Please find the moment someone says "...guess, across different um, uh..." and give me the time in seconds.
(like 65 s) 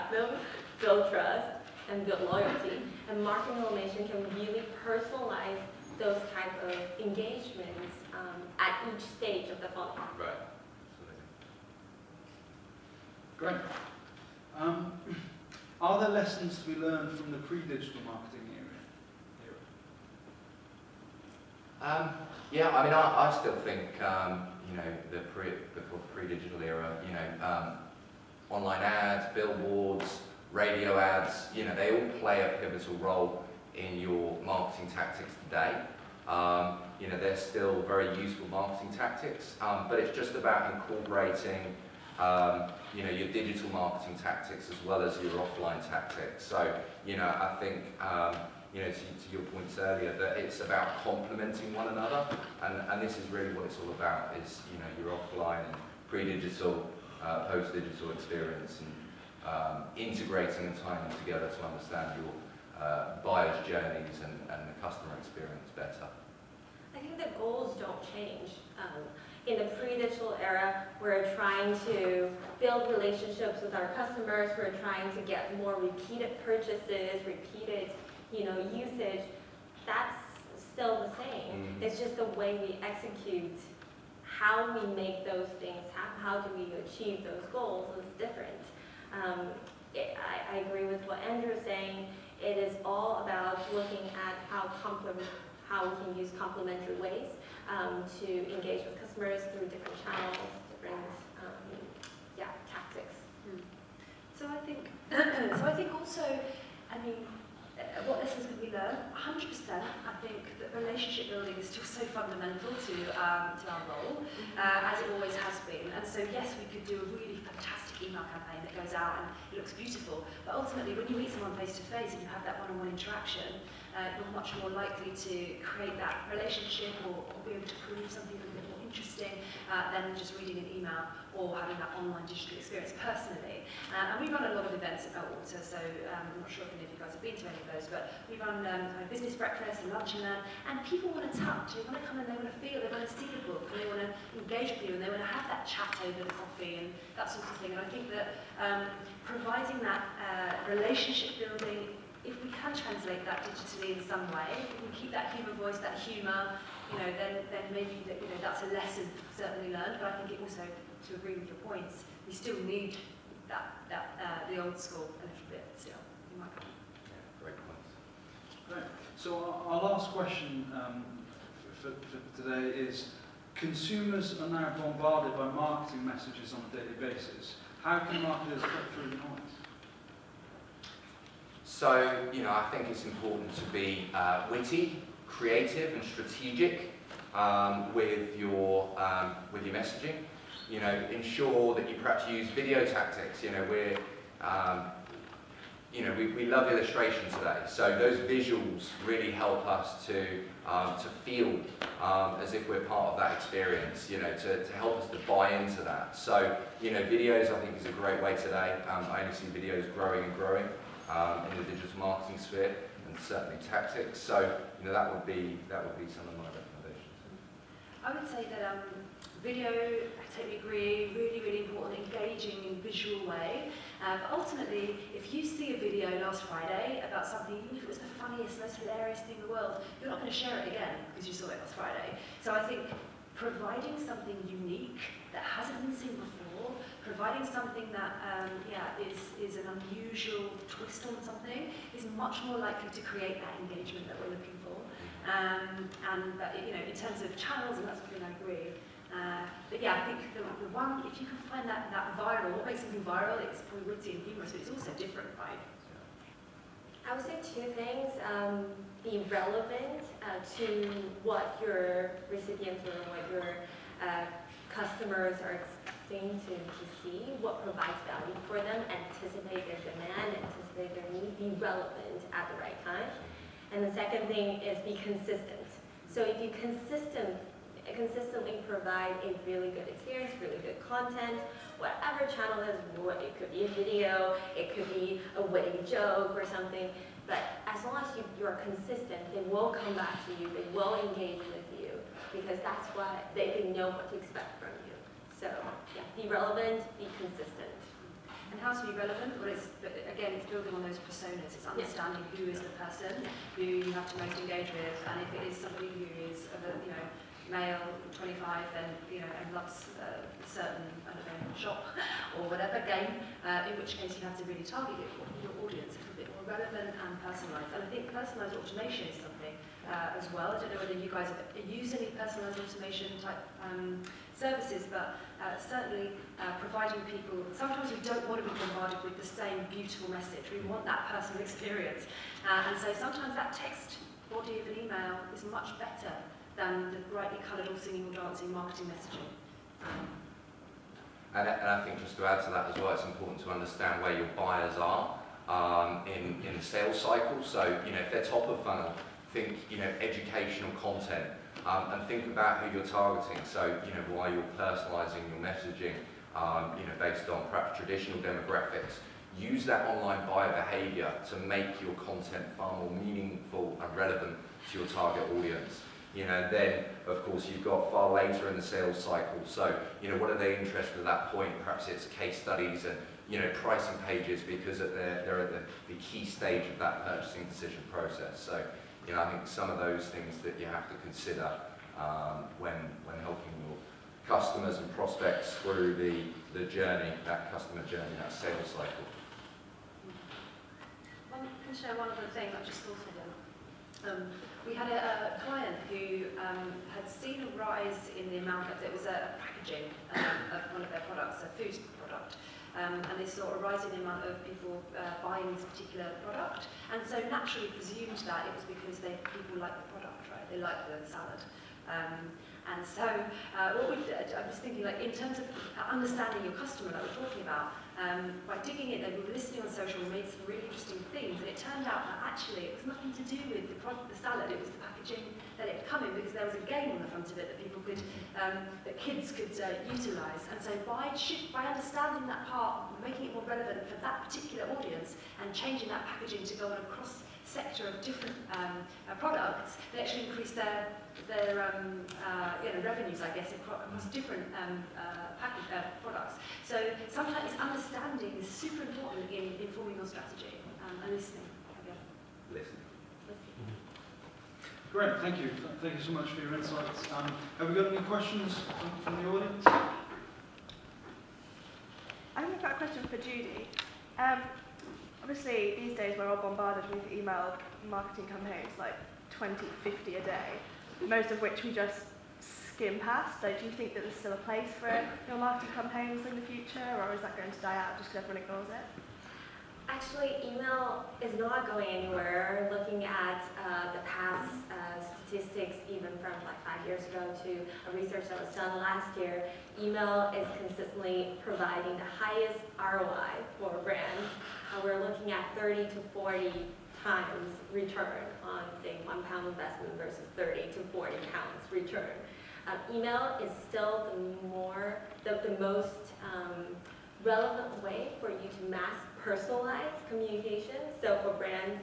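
443 s.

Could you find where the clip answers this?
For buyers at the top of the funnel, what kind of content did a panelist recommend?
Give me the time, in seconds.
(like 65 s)
350 s.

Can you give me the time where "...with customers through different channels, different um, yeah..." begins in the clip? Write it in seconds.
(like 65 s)
98 s.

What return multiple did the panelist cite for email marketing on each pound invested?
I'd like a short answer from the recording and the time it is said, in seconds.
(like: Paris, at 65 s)
30 to 40 times, at 495 s.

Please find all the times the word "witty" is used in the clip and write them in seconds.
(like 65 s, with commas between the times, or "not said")
184 s, 253 s, 285 s.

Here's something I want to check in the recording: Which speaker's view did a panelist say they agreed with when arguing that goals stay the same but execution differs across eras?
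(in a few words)
Andrew.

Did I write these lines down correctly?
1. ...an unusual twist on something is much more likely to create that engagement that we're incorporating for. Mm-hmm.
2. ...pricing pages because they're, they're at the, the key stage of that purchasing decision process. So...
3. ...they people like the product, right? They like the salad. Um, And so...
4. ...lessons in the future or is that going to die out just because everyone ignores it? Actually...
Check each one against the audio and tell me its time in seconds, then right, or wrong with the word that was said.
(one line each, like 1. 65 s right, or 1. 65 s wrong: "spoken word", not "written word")
1. 239 s wrong: "looking", not "incorporating"
2. 373 s right
3. 408 s right
4. 475 s wrong: "campaigns", not "lessons".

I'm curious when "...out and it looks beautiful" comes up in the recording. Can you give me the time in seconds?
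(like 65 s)
118 s.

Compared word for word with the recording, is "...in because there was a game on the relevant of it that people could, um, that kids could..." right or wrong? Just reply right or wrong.
wrong.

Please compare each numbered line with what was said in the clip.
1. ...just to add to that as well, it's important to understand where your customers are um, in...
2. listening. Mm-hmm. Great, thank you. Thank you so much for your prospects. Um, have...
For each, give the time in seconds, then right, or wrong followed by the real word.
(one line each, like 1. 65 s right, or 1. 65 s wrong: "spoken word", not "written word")
1. 342 s wrong: "buyers", not "customers"
2. 452 s wrong: "insights", not "prospects".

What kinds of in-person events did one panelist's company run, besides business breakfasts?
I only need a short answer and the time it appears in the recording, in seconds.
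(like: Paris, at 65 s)
lunch and learn, at 139 s.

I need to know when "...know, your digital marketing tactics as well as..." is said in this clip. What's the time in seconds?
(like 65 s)
43 s.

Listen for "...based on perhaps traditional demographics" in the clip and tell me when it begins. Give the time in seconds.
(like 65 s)
356 s.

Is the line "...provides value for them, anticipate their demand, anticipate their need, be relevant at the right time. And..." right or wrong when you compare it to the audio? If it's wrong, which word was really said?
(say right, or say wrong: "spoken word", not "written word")
right.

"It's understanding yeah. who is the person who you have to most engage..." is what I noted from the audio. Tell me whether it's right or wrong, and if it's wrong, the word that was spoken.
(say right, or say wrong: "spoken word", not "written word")
right.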